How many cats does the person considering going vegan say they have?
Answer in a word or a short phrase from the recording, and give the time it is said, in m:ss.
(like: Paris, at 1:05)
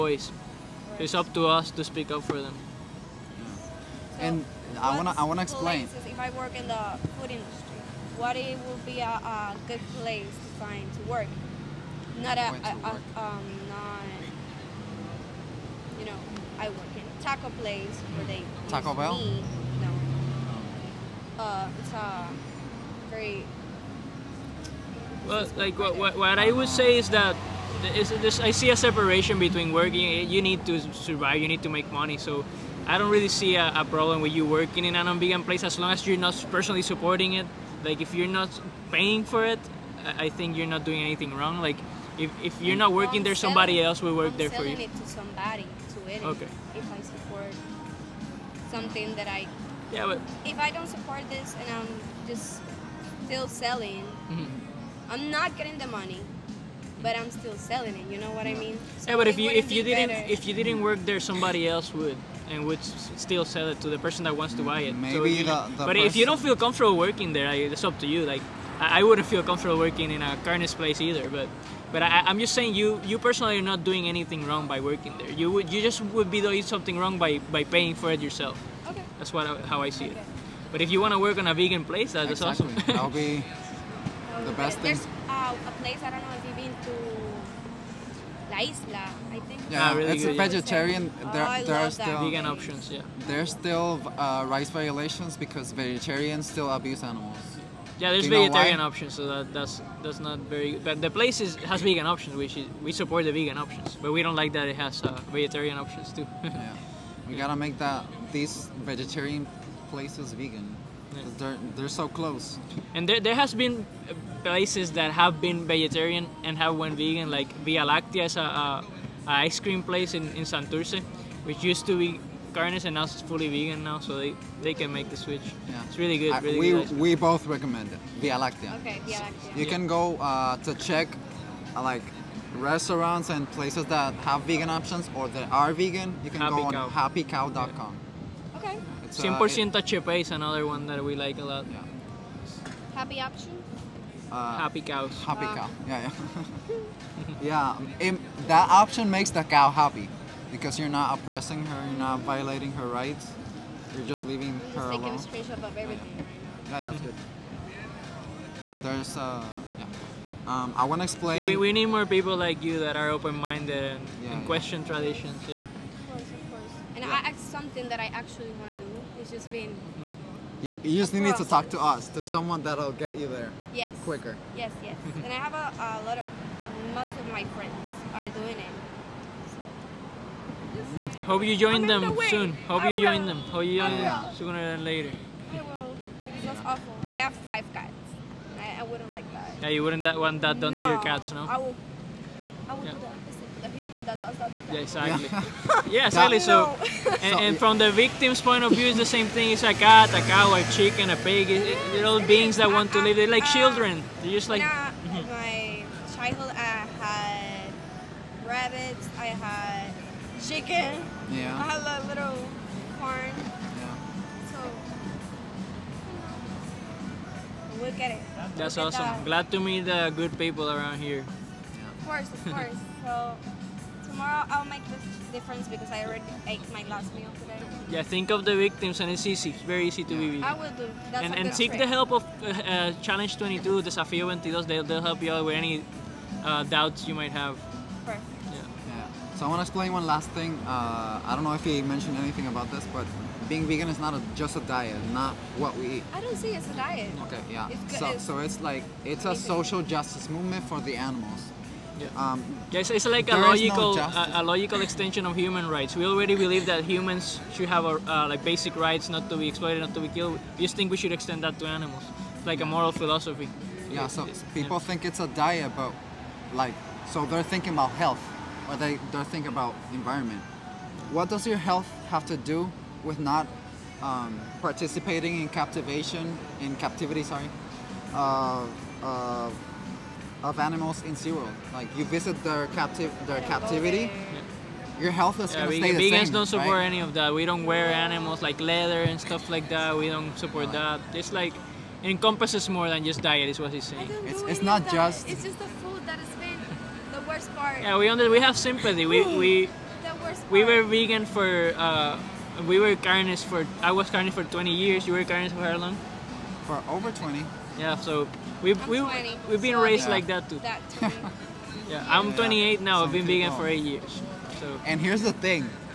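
5, at 3:07.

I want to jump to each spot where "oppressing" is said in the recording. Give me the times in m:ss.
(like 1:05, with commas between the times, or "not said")
2:31.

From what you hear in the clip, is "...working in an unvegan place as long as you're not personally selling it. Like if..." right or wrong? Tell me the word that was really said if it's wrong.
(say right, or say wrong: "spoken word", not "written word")
wrong: "supporting", not "selling".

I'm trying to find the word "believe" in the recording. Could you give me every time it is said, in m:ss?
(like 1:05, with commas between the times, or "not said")
4:16.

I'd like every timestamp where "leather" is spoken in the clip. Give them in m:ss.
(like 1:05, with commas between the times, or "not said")
4:48.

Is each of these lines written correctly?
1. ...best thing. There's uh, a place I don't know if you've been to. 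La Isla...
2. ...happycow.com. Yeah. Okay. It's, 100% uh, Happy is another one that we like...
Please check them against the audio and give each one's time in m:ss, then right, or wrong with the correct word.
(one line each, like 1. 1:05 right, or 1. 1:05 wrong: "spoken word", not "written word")
1. 1:24 right
2. 2:16 wrong: "Chepe", not "Happy".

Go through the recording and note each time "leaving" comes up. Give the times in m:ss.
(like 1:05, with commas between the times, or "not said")
2:34.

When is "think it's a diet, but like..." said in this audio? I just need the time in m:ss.
4:24.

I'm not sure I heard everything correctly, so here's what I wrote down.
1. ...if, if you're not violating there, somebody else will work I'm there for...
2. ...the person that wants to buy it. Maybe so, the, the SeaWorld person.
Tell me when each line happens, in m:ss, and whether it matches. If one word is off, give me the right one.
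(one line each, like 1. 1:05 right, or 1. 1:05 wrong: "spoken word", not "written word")
1. 0:42 wrong: "working", not "violating"
2. 1:03 wrong: "But", not "SeaWorld".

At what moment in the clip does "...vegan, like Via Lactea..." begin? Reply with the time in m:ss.
1:56.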